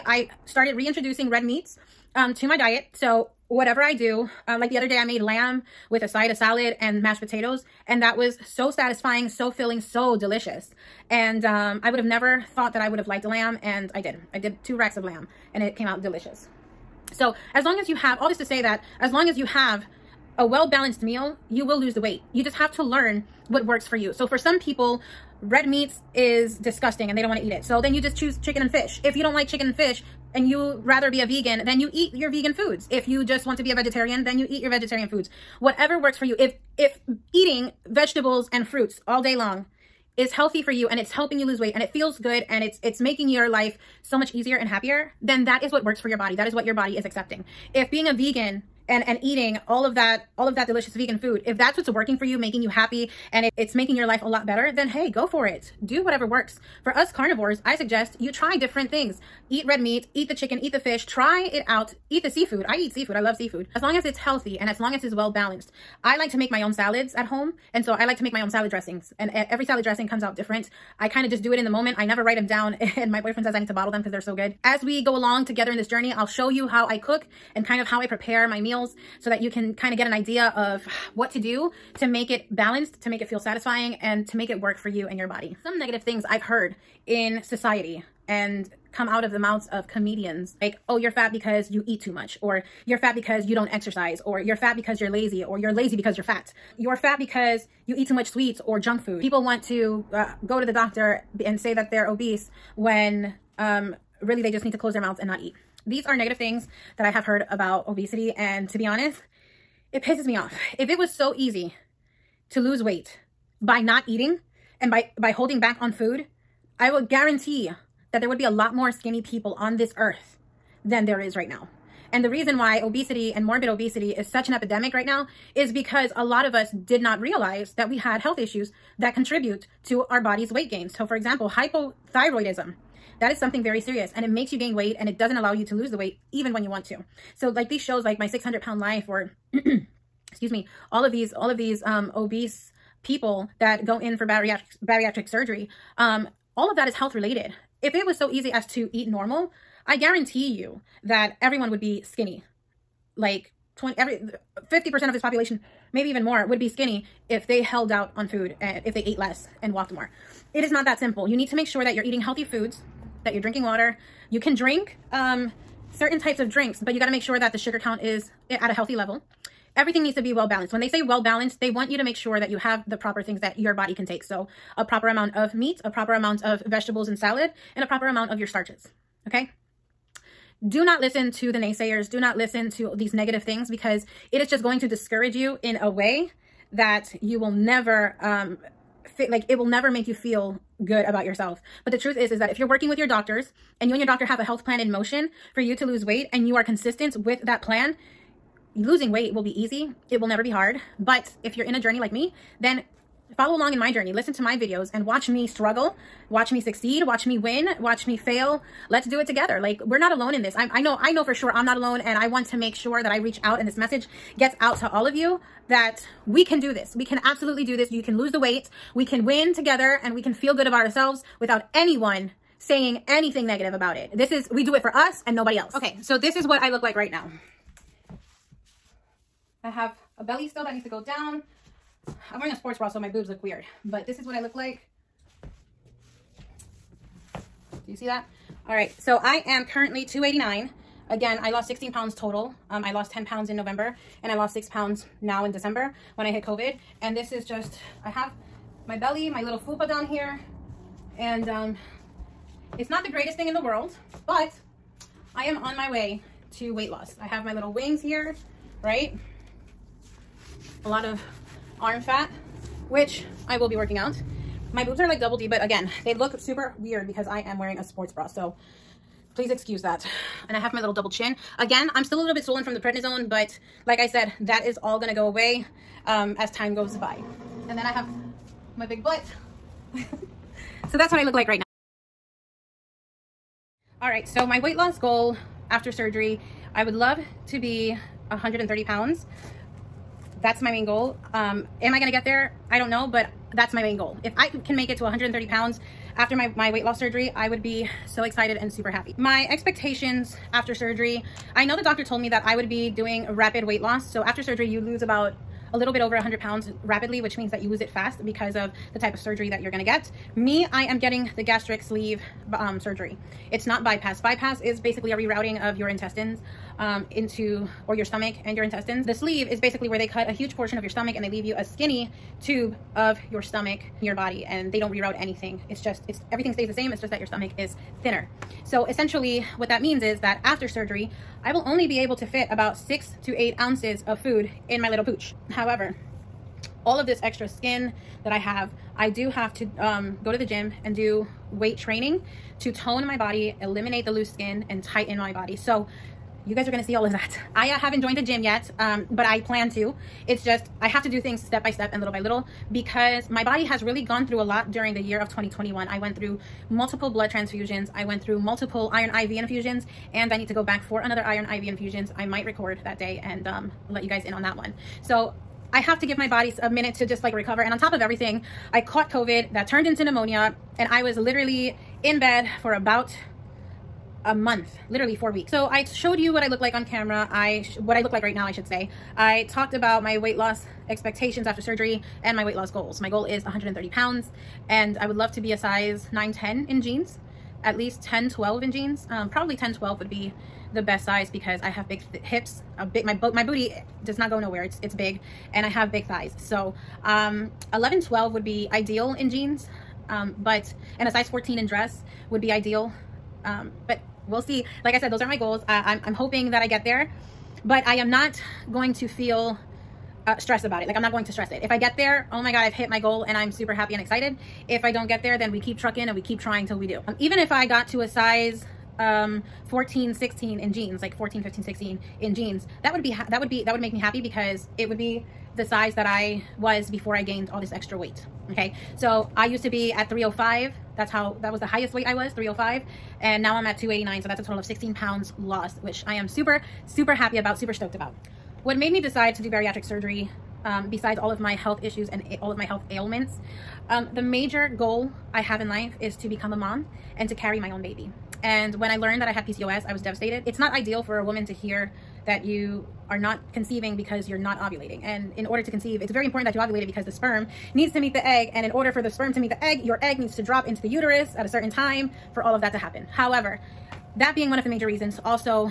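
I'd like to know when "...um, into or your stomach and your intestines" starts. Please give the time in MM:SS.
05:16.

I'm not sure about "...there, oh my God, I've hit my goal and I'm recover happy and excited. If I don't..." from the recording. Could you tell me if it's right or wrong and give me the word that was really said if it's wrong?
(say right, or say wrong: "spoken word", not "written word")
wrong: "super", not "recover".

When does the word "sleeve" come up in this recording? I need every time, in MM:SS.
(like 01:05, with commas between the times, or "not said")
05:11, 05:19.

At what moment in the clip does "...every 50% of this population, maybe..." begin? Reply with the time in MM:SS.
02:33.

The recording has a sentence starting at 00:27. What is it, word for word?
So then you just choose chicken and fish.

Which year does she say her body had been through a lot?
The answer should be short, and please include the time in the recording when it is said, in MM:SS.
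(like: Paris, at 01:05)
2021, at 05:55.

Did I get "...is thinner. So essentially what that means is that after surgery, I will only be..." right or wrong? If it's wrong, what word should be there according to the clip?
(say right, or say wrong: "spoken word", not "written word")
right.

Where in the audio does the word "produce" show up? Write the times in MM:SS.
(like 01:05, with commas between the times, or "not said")
not said.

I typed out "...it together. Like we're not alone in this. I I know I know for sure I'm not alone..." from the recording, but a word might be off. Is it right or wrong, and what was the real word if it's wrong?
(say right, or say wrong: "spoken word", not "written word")
right.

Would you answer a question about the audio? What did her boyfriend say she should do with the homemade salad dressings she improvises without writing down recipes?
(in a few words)
bottle them.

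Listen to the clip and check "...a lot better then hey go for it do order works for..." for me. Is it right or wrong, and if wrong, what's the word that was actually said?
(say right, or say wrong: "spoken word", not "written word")
wrong: "whatever", not "order".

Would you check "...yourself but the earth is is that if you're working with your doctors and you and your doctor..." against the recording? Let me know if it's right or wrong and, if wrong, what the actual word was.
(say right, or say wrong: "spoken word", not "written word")
wrong: "truth", not "earth".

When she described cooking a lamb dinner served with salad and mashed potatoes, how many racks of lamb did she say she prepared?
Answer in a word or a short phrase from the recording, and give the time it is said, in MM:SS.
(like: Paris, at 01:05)
2, at 00:14.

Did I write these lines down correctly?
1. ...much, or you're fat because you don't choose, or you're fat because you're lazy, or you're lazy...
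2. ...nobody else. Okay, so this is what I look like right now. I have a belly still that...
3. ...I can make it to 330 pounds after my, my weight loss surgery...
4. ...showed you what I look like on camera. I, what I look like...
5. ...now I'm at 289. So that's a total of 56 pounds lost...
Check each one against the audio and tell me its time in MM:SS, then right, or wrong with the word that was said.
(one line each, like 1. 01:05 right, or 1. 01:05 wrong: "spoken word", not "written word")
1. 01:32 wrong: "exercise", not "choose"
2. 03:45 right
3. 04:54 wrong: "130", not "330"
4. 06:15 right
5. 07:13 wrong: "16", not "56".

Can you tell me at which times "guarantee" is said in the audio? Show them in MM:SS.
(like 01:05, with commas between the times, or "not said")
01:57, 02:29.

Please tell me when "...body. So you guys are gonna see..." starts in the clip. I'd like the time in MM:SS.
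05:45.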